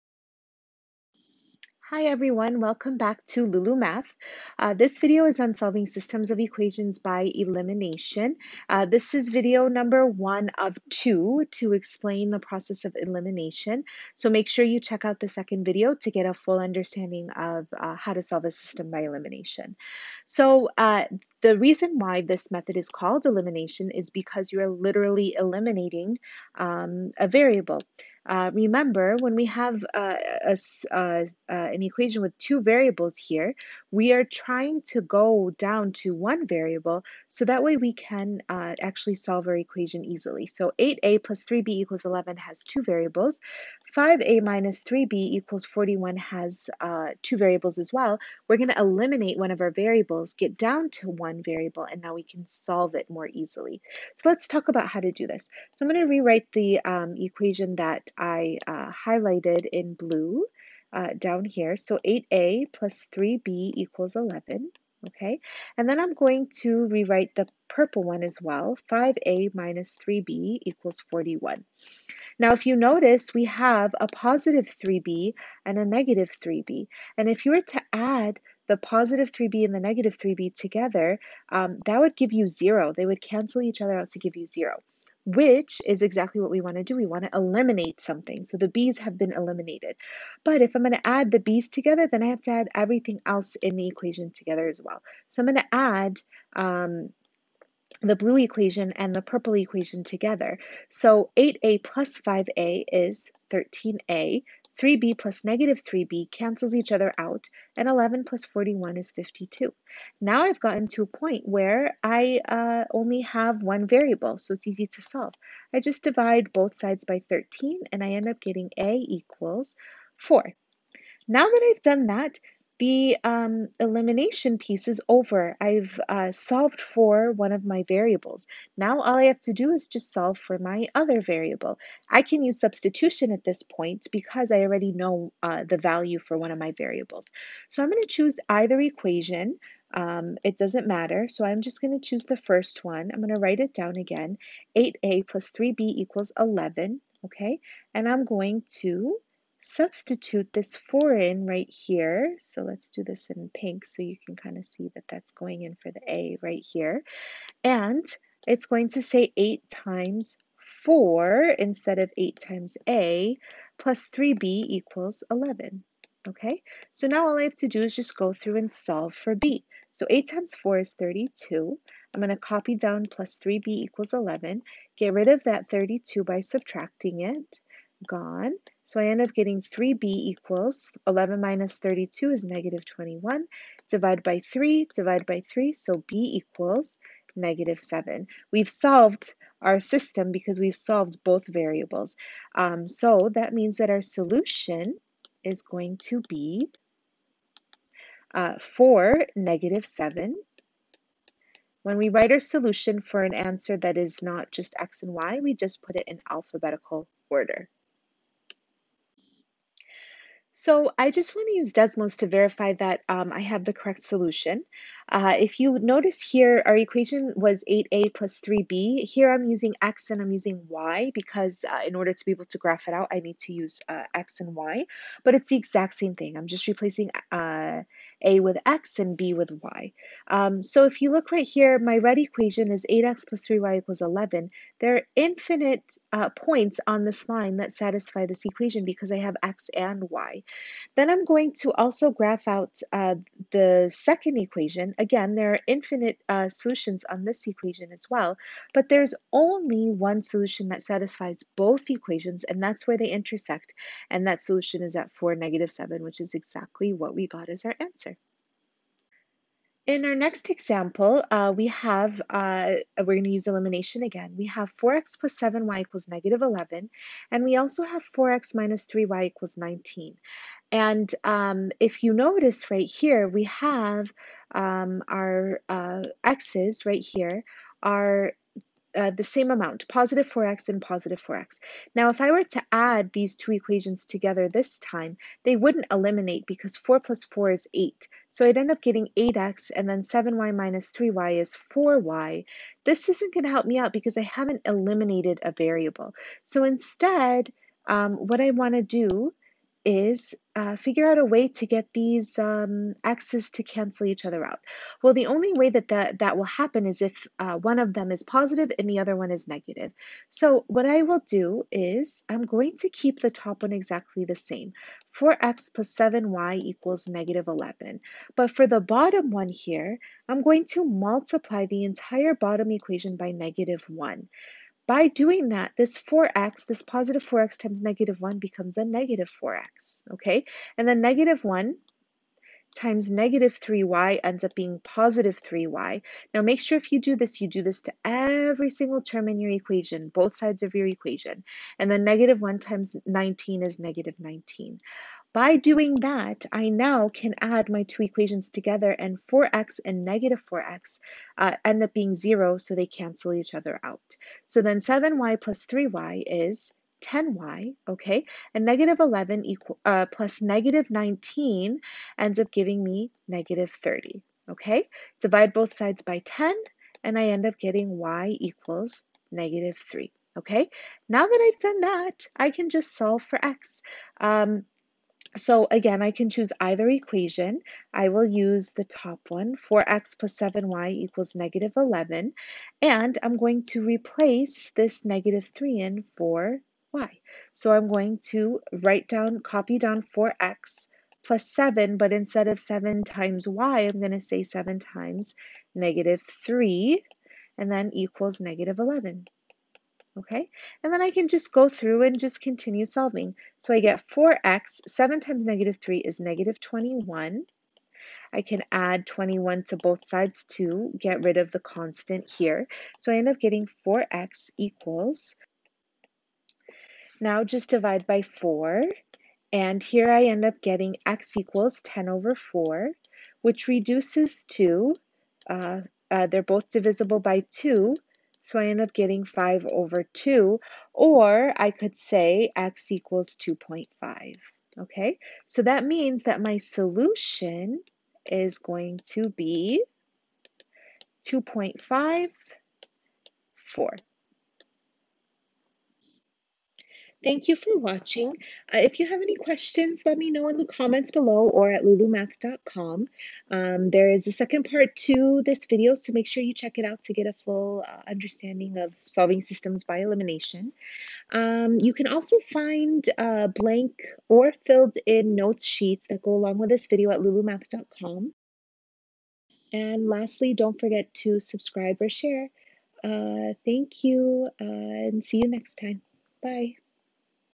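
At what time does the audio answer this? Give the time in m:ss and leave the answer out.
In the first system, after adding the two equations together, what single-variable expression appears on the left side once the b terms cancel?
1:43.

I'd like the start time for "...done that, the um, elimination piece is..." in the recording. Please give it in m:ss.
2:01.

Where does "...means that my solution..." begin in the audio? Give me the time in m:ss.
7:15.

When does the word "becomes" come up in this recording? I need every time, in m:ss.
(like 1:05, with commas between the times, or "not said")
5:28.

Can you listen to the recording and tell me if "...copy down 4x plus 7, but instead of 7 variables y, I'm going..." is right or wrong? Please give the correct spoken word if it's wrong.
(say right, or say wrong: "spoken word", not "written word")
wrong: "times", not "variables".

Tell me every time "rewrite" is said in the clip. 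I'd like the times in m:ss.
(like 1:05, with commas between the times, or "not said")
0:56, 1:06.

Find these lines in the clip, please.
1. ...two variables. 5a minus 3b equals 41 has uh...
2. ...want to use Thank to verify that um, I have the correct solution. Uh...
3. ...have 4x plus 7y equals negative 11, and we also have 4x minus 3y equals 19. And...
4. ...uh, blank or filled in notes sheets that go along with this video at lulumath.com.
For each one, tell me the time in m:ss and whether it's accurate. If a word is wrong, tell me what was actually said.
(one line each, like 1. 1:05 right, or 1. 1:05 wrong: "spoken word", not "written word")
1. 0:42 right
2. 3:31 wrong: "Desmos", not "Thank"
3. 4:24 right
4. 7:43 right.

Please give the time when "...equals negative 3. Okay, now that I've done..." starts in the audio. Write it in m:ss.
6:08.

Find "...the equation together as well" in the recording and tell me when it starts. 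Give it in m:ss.
1:33.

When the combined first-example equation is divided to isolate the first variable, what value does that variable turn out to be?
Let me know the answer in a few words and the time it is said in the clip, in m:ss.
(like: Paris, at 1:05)
4, at 1:58.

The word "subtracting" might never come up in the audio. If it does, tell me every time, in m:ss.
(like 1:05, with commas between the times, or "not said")
2:56.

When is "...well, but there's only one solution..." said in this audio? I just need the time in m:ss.
4:08.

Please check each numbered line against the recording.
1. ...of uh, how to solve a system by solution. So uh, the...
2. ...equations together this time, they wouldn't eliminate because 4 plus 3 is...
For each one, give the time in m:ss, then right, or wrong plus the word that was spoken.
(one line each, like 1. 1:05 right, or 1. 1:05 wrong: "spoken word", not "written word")
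1. 0:17 wrong: "elimination", not "solution"
2. 4:43 wrong: "4", not "3".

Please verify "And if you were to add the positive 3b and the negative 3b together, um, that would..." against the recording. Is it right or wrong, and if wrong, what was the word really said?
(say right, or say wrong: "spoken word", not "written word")
right.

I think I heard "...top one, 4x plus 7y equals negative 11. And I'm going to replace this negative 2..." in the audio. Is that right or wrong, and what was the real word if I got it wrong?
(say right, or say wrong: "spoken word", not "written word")
wrong: "3", not "2".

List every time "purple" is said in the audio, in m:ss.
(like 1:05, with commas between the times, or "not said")
1:07, 1:39.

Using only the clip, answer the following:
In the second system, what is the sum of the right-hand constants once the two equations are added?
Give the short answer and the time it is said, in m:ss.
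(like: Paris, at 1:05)
-30, at 6:03.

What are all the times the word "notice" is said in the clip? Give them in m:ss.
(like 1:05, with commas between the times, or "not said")
1:12, 3:35, 4:32.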